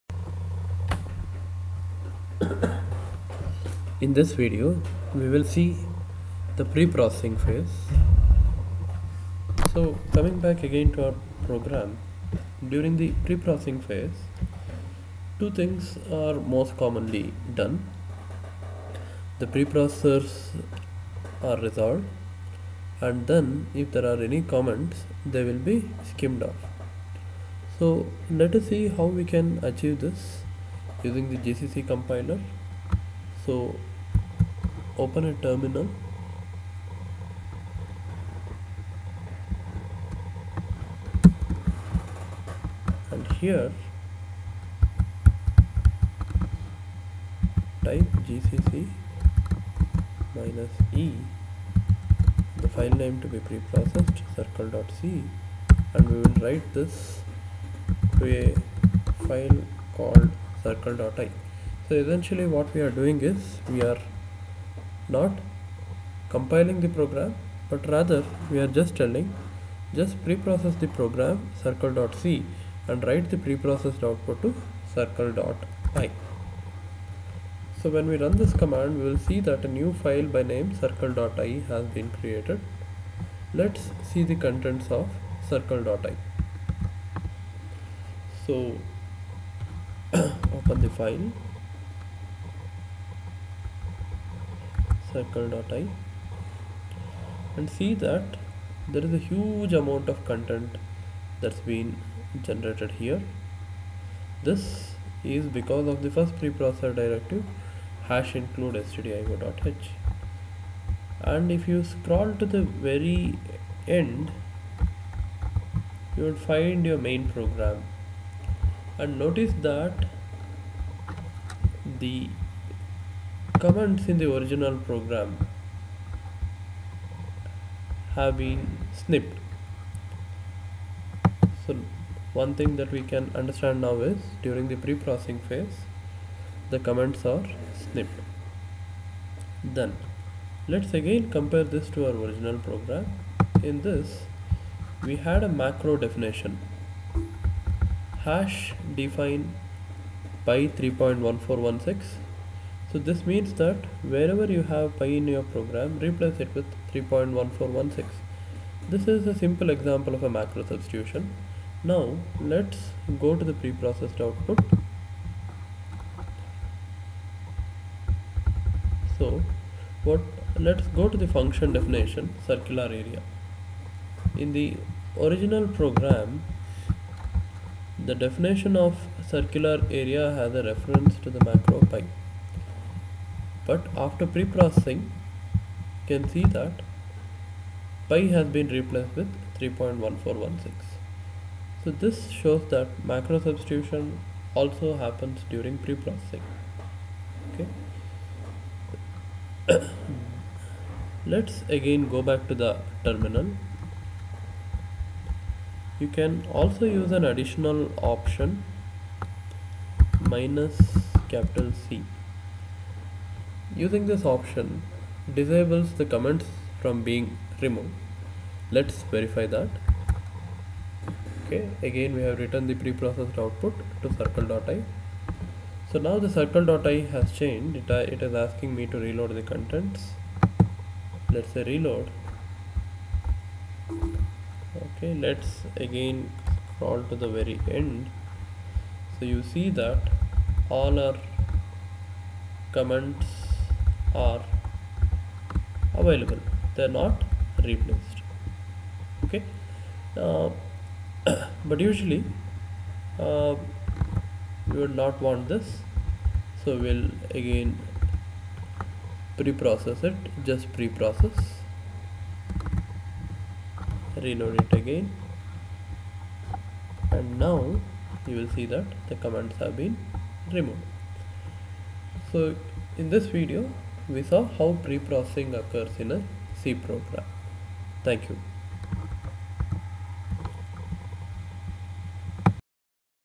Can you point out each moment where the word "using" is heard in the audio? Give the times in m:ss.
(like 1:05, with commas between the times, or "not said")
0:31, 3:33.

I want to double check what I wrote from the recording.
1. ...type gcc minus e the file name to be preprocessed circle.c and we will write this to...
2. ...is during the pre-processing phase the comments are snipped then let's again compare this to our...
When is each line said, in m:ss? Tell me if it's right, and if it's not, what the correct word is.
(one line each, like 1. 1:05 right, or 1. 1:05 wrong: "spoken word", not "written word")
1. 0:47 right
2. 2:14 right.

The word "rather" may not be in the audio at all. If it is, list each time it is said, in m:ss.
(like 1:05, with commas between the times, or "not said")
1:07.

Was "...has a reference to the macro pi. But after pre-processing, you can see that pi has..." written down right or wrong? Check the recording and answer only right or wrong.
right.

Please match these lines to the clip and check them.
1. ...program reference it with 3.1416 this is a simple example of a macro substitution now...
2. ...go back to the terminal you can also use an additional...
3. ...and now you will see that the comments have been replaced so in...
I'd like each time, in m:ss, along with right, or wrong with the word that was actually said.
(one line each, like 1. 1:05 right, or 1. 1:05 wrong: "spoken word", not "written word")
1. 2:35 wrong: "replace", not "reference"
2. 3:22 right
3. 4:27 wrong: "removed", not "replaced".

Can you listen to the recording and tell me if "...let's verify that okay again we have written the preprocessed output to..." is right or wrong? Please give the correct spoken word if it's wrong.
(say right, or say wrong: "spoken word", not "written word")
right.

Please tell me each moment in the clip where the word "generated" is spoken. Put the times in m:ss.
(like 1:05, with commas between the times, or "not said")
1:42.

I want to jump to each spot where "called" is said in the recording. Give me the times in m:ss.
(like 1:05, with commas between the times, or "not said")
0:59.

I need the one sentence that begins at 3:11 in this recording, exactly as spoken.
So this shows that macro substitution also happens during pre-processing.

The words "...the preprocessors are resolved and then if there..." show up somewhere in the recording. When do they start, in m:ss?
0:19.